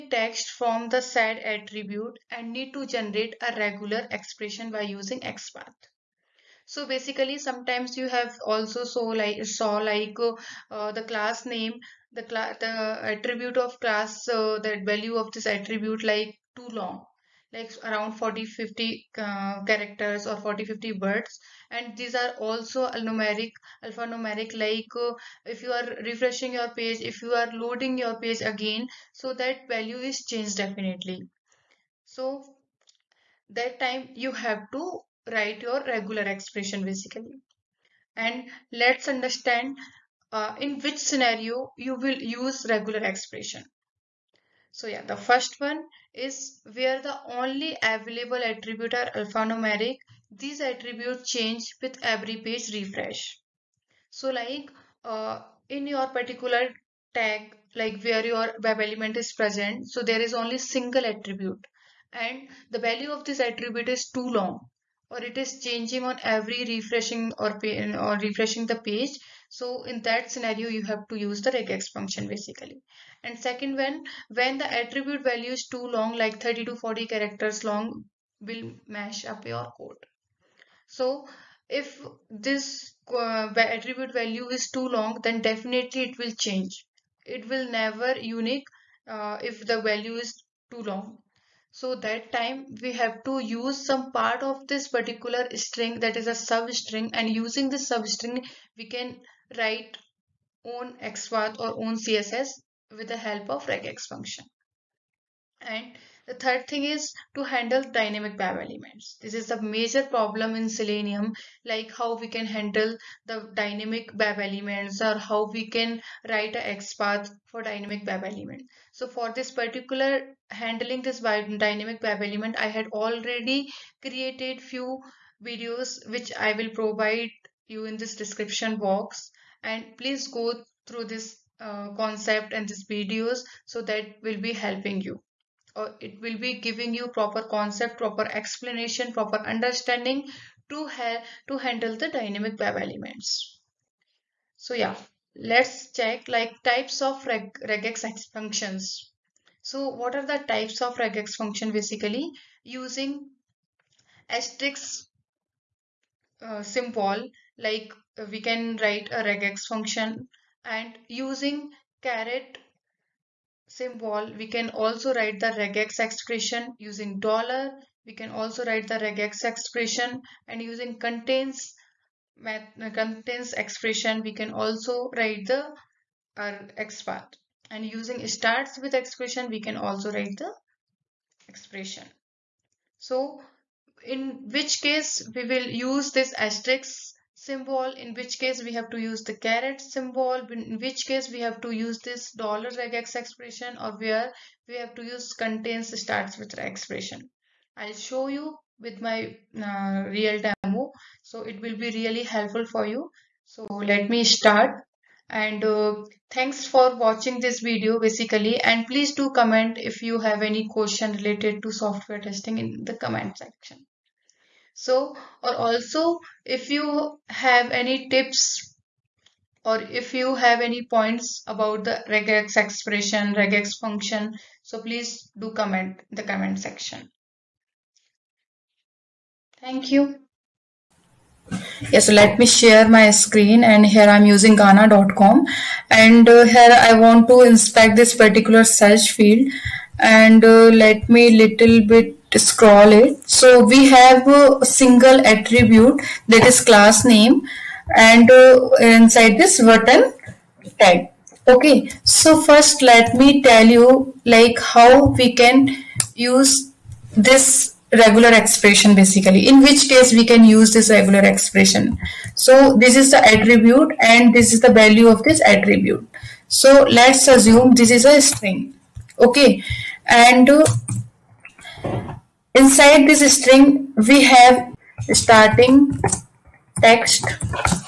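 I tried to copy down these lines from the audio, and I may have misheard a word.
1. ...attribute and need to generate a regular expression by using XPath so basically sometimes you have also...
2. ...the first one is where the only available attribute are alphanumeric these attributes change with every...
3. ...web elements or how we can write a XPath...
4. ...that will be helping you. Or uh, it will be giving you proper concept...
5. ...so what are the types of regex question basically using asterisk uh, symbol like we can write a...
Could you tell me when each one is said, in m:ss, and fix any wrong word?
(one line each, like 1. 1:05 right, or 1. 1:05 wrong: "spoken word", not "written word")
1. 0:01 right
2. 0:45 right
3. 1:54 right
4. 2:13 right
5. 2:29 wrong: "function", not "question".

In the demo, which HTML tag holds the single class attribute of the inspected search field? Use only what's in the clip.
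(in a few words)
button.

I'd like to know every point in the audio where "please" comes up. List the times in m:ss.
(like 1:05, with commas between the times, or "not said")
2:09, 3:28, 3:44.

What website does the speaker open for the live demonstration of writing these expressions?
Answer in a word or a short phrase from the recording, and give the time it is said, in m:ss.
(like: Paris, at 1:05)
Gaana.com, at 3:54.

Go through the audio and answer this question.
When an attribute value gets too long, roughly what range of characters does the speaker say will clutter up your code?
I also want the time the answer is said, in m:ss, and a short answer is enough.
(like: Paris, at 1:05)
30 to 40, at 1:16.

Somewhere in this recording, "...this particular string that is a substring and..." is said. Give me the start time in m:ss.
1:34.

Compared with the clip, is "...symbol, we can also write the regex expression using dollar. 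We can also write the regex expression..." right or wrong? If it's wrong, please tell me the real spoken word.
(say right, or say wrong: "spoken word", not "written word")
right.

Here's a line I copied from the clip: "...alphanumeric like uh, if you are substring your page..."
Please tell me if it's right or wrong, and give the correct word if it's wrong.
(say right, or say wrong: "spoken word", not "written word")
wrong: "refreshing", not "substring".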